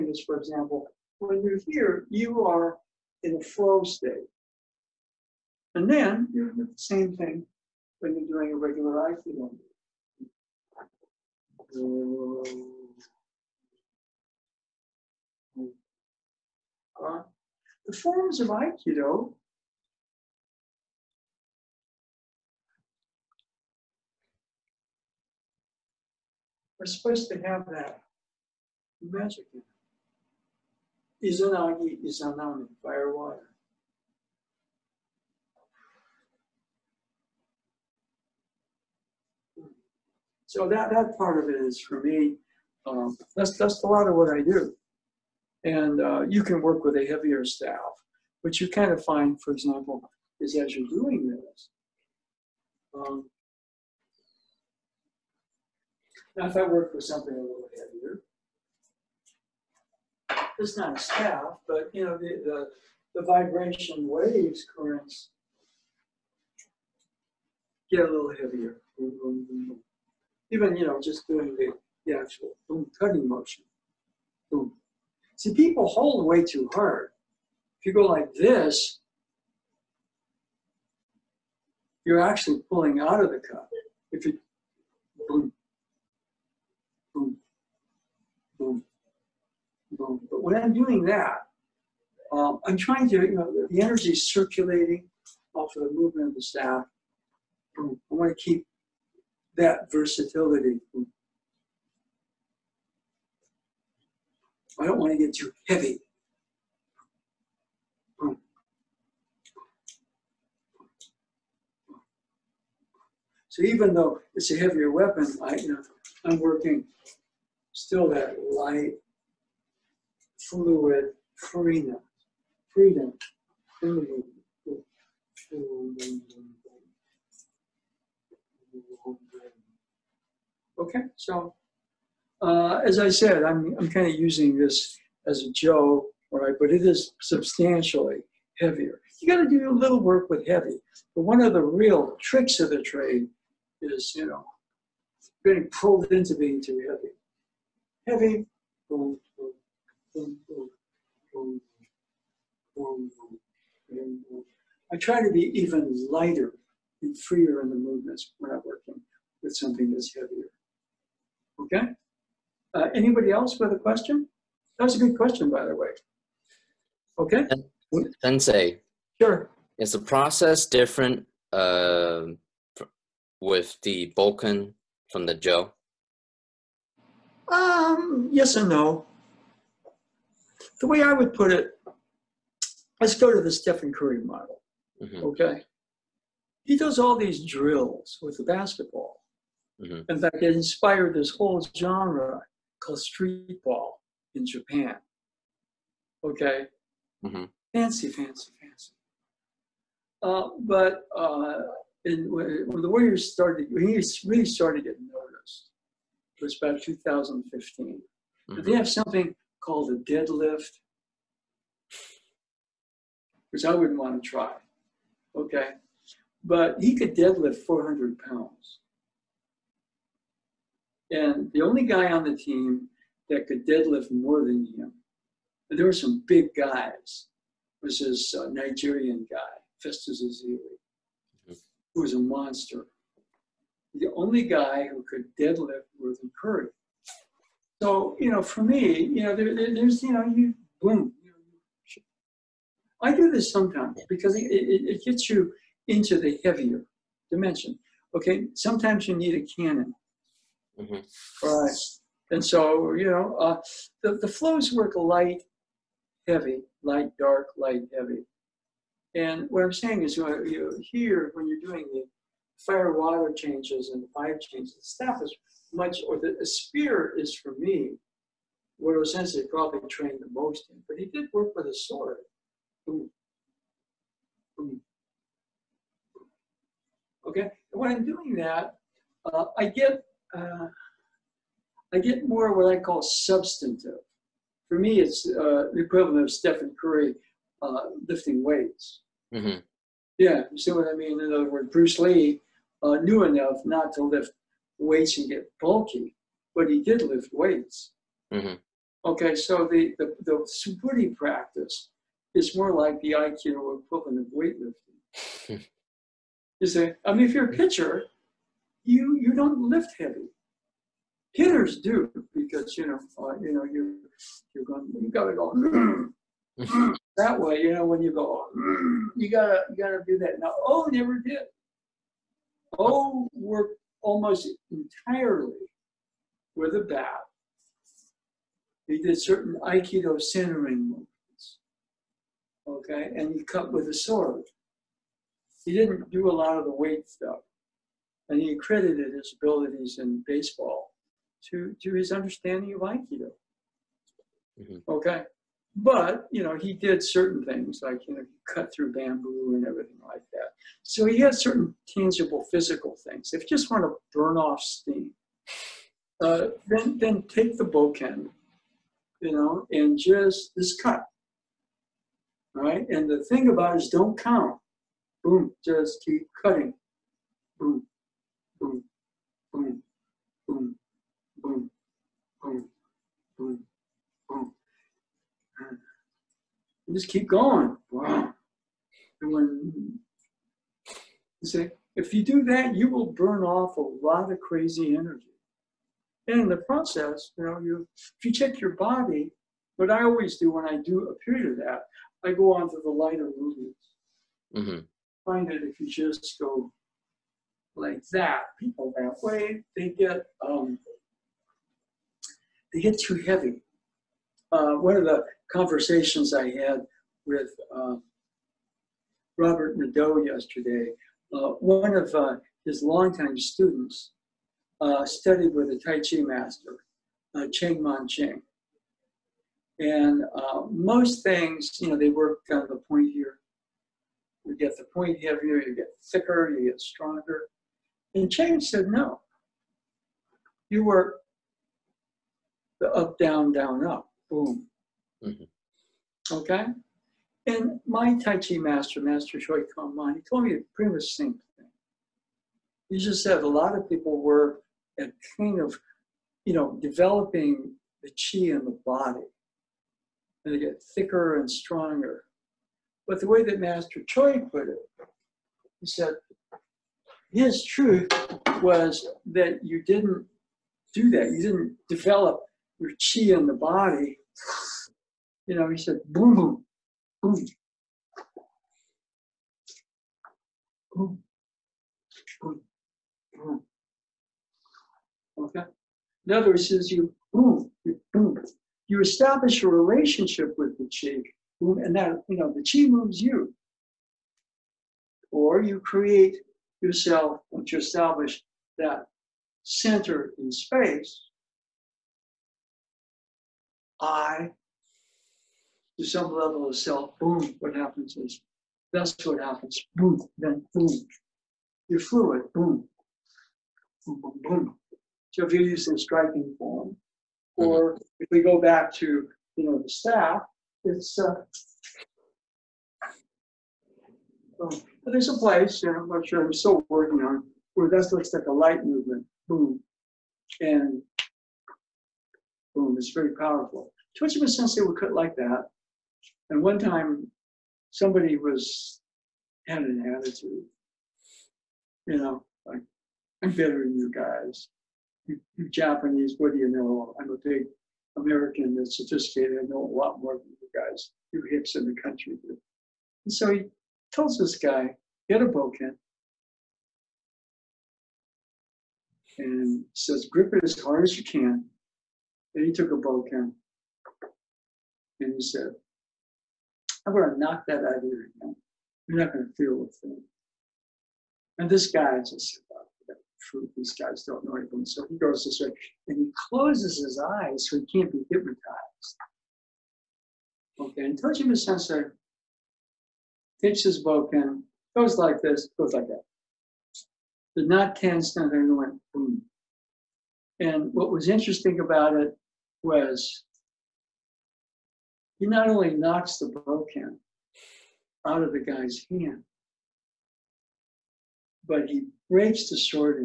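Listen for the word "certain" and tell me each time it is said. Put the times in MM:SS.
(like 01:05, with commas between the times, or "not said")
05:29, 05:47, 05:51.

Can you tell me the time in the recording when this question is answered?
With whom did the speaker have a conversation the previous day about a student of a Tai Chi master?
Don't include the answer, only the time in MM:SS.
06:49.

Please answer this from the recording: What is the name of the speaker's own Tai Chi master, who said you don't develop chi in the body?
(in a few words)
Choi Kong Man.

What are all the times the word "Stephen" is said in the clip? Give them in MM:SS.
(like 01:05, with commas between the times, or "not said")
03:03, 04:46.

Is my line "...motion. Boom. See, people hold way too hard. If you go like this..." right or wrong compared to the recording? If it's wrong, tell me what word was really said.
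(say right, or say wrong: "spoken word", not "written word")
right.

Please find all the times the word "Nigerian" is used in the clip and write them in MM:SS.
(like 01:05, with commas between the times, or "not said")
03:48.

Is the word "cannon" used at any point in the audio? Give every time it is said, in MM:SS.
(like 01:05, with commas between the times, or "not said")
04:09.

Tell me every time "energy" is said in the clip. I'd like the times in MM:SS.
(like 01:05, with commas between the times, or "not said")
01:33, 06:24.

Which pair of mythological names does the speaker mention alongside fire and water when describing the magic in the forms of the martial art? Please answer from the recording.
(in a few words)
Izanagi, Izanami.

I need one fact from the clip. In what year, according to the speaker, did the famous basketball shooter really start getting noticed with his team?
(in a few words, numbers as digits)
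2015.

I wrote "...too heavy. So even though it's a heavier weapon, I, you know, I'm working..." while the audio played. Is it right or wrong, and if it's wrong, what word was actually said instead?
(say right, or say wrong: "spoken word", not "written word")
right.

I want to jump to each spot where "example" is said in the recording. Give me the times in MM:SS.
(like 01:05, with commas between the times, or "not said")
00:00, 00:49.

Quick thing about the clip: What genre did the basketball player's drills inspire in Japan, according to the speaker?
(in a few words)
street ball.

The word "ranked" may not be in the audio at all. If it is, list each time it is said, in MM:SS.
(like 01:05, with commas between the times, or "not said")
not said.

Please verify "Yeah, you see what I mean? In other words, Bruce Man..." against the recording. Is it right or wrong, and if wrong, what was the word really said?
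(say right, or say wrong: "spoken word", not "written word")
wrong: "Lee", not "Man".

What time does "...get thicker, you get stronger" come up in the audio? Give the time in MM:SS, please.
07:05.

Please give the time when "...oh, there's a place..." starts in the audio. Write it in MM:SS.
08:34.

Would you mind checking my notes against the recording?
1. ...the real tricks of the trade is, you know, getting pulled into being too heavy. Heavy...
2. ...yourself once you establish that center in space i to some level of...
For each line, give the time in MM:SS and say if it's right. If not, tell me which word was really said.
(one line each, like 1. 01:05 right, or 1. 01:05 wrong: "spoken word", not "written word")
1. 02:21 right
2. 08:06 right.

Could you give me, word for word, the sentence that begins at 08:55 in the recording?
You, you Japanese, what do you know?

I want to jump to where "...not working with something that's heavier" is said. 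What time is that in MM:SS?
02:38.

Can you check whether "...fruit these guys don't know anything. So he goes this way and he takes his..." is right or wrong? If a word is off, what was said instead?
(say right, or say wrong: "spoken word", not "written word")
wrong: "closes", not "takes".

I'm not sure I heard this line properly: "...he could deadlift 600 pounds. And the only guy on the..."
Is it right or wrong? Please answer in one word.
wrong.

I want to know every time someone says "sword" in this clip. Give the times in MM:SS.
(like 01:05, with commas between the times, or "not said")
04:31, 05:33.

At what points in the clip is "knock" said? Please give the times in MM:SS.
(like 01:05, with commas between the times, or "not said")
09:17, 09:45.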